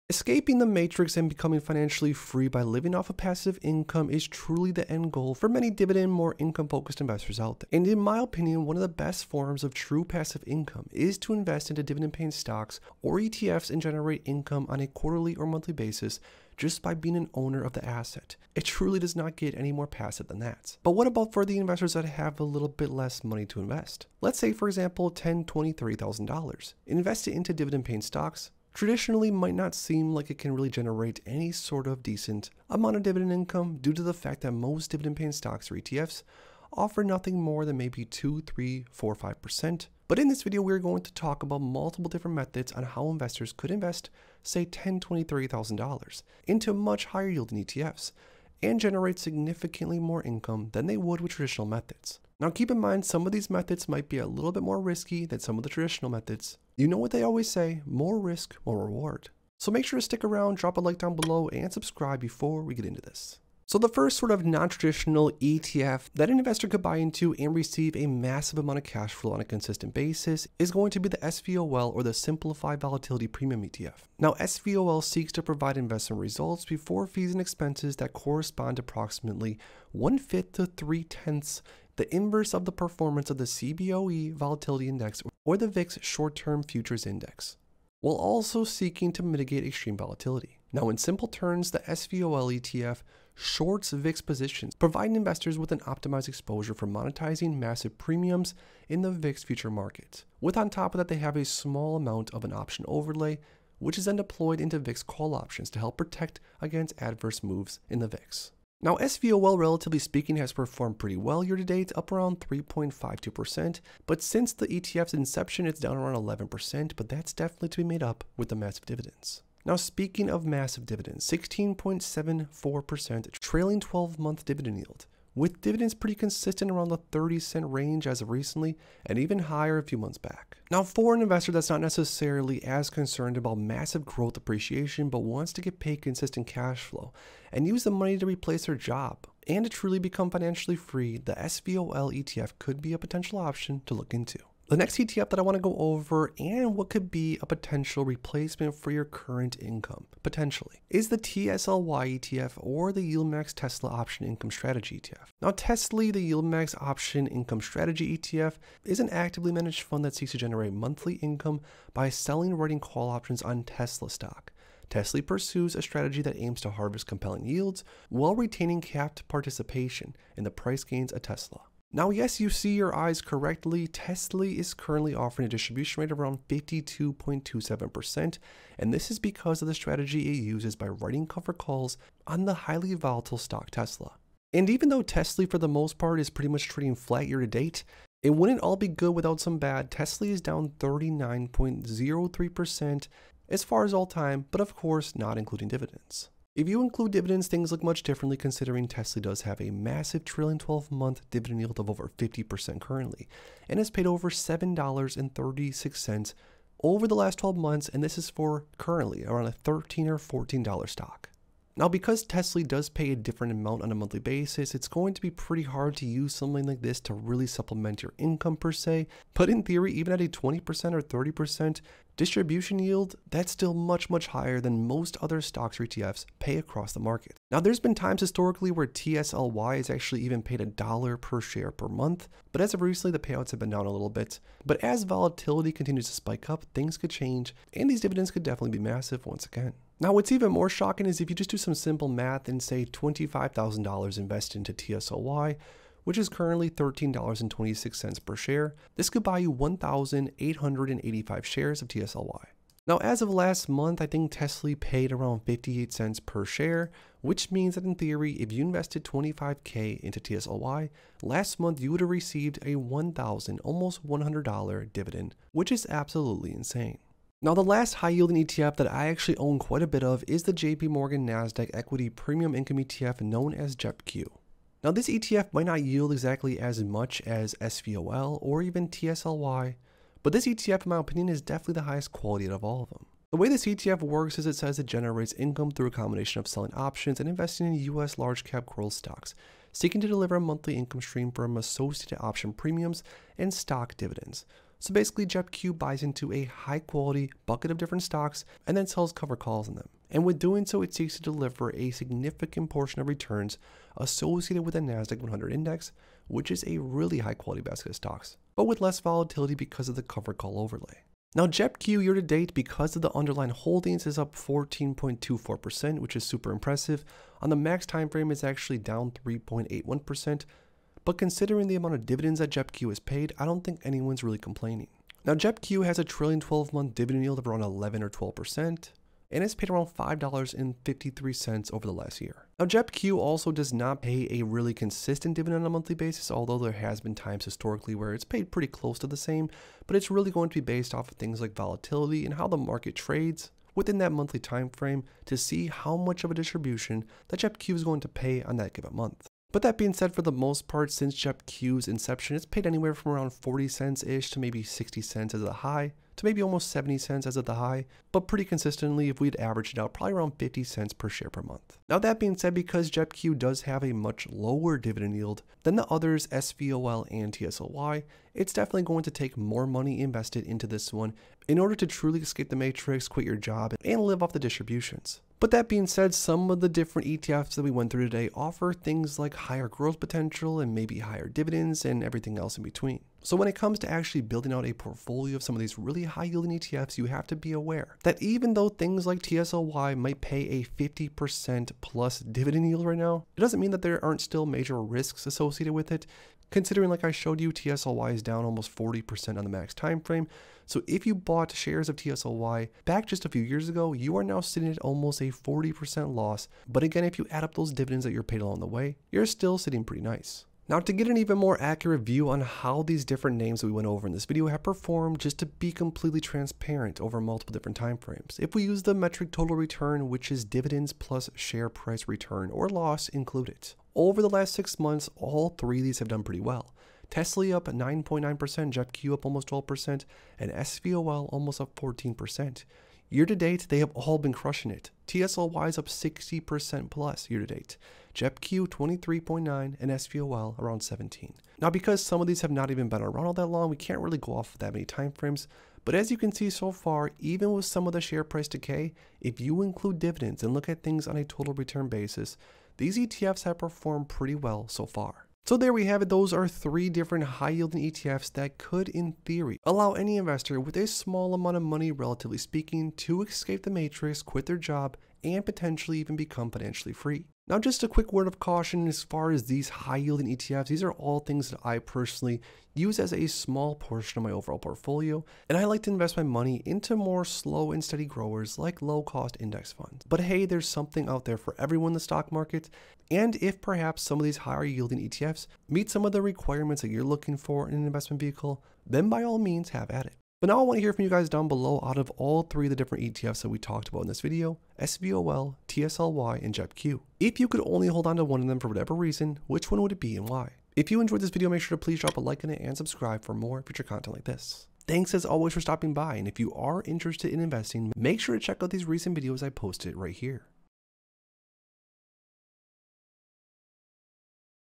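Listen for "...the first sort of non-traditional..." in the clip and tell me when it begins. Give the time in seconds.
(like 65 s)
63 s.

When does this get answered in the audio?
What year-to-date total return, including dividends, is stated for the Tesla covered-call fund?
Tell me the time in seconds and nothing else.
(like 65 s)
435 s.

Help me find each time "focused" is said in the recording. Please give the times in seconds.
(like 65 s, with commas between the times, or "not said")
6 s.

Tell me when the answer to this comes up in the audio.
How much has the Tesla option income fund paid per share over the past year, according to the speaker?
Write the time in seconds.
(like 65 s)
204 s.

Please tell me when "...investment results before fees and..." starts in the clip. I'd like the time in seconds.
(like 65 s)
75 s.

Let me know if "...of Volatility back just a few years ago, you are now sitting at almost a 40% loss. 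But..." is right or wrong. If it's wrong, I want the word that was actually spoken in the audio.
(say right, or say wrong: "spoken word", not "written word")
wrong: "TSLY", not "Volatility".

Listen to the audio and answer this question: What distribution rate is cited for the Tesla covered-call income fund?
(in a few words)
52.27%.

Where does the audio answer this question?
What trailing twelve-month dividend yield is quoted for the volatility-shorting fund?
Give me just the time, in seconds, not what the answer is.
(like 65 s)
121 s.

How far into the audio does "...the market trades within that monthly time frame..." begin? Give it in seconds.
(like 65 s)
342 s.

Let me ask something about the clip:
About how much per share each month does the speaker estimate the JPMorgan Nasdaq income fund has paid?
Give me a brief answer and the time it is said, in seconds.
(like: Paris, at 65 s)
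50 cents, at 360 s.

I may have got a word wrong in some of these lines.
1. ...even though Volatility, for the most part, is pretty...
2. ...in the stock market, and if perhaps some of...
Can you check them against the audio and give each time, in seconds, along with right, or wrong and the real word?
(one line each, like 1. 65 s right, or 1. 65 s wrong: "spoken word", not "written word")
1. 184 s wrong: "Tesla", not "Volatility"
2. 481 s right.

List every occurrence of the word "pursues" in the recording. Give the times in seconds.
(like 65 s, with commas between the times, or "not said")
165 s.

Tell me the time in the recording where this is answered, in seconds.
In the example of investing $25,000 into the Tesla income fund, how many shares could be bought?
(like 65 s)
249 s.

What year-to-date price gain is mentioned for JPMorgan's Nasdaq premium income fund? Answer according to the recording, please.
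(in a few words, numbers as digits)
14.24%.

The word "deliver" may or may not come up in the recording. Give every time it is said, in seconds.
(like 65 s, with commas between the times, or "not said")
290 s, 301 s.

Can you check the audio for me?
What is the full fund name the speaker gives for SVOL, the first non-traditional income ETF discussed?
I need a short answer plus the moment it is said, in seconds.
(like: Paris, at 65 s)
Simplified Volatility Premium ETF, at 72 s.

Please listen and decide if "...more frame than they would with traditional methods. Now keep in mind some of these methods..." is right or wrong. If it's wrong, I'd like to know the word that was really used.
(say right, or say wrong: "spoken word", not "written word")
wrong: "income", not "frame".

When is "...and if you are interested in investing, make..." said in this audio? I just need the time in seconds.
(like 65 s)
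506 s.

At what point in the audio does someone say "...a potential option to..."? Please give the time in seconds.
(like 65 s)
142 s.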